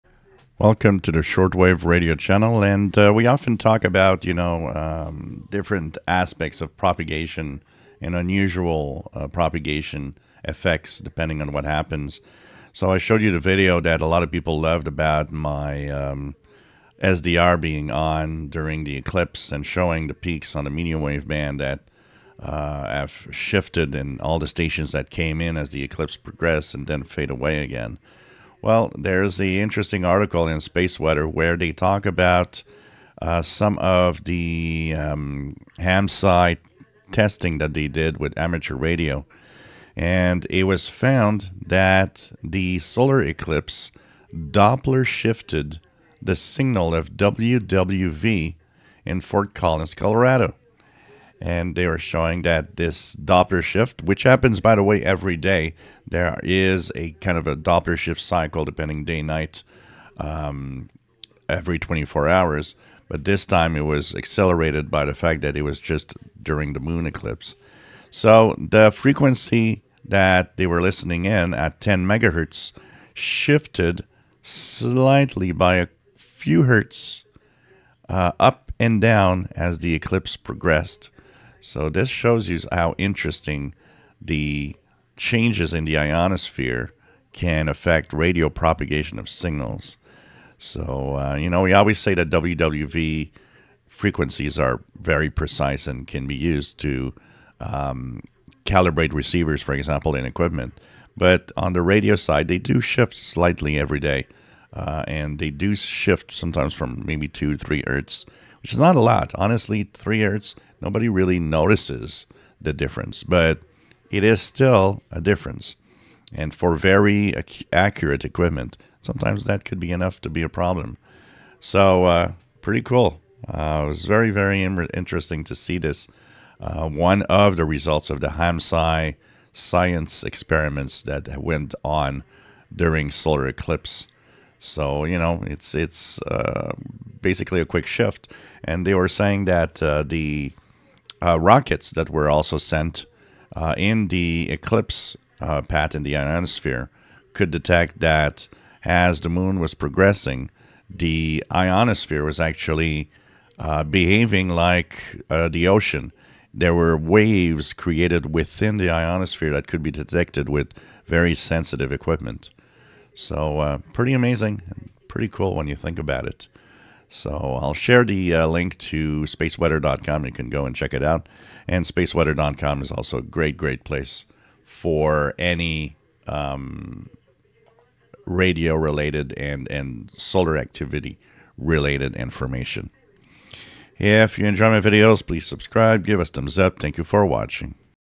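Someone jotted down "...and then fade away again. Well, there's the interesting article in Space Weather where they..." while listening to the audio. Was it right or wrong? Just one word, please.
right.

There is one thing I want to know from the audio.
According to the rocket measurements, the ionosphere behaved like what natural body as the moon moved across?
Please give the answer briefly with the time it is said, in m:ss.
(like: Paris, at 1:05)
the ocean, at 2:35.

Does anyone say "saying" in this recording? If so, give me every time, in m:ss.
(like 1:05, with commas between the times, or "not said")
2:19.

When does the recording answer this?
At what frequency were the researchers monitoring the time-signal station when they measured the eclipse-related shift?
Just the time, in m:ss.
1:11.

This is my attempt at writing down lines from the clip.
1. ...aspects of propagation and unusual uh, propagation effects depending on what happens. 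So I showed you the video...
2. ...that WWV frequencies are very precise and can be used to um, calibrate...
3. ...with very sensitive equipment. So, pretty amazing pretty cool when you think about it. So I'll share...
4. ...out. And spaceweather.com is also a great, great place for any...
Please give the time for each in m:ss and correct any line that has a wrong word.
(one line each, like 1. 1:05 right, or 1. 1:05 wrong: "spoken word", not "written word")
1. 0:06 right
2. 1:32 right
3. 2:40 right
4. 2:51 right.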